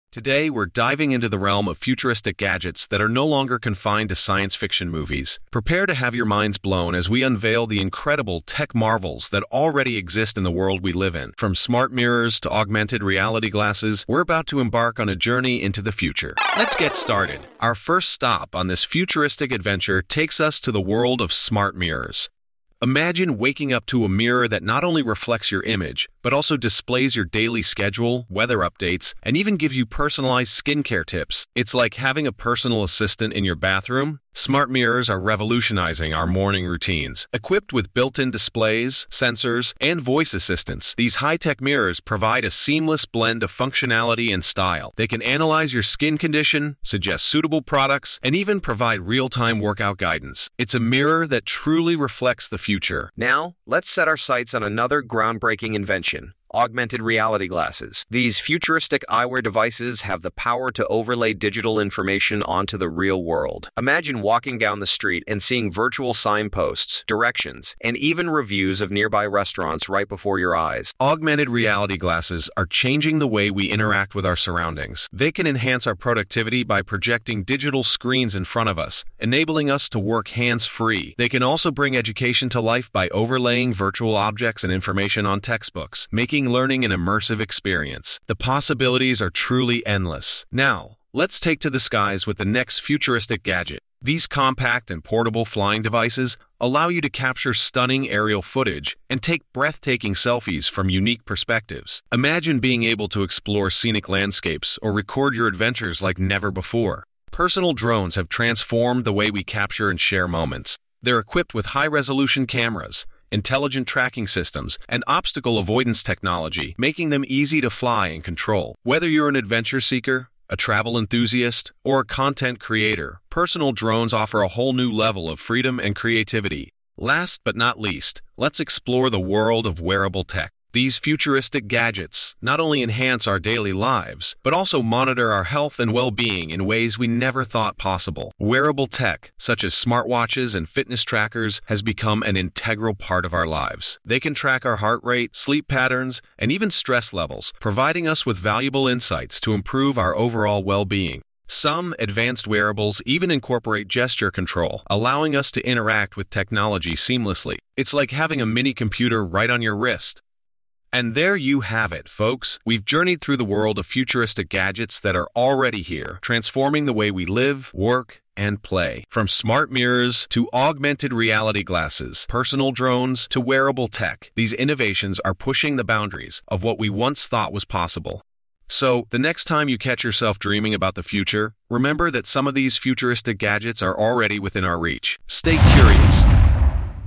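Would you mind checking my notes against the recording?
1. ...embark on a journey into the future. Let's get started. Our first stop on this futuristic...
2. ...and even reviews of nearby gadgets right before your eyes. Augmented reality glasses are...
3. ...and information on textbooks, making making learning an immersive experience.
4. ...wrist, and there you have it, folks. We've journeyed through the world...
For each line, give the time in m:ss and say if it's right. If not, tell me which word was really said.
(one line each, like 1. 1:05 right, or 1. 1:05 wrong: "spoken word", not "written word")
1. 0:14 right
2. 1:07 wrong: "restaurants", not "gadgets"
3. 1:24 right
4. 2:39 right.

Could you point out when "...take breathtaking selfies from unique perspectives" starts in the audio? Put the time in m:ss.
1:39.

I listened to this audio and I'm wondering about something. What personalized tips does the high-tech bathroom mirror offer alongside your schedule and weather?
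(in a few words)
skincare tips.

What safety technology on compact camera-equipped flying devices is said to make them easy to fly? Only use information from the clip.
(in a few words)
obstacle avoidance technology.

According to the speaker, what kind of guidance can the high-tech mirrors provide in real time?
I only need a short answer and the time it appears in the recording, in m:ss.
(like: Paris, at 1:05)
workout guidance, at 0:49.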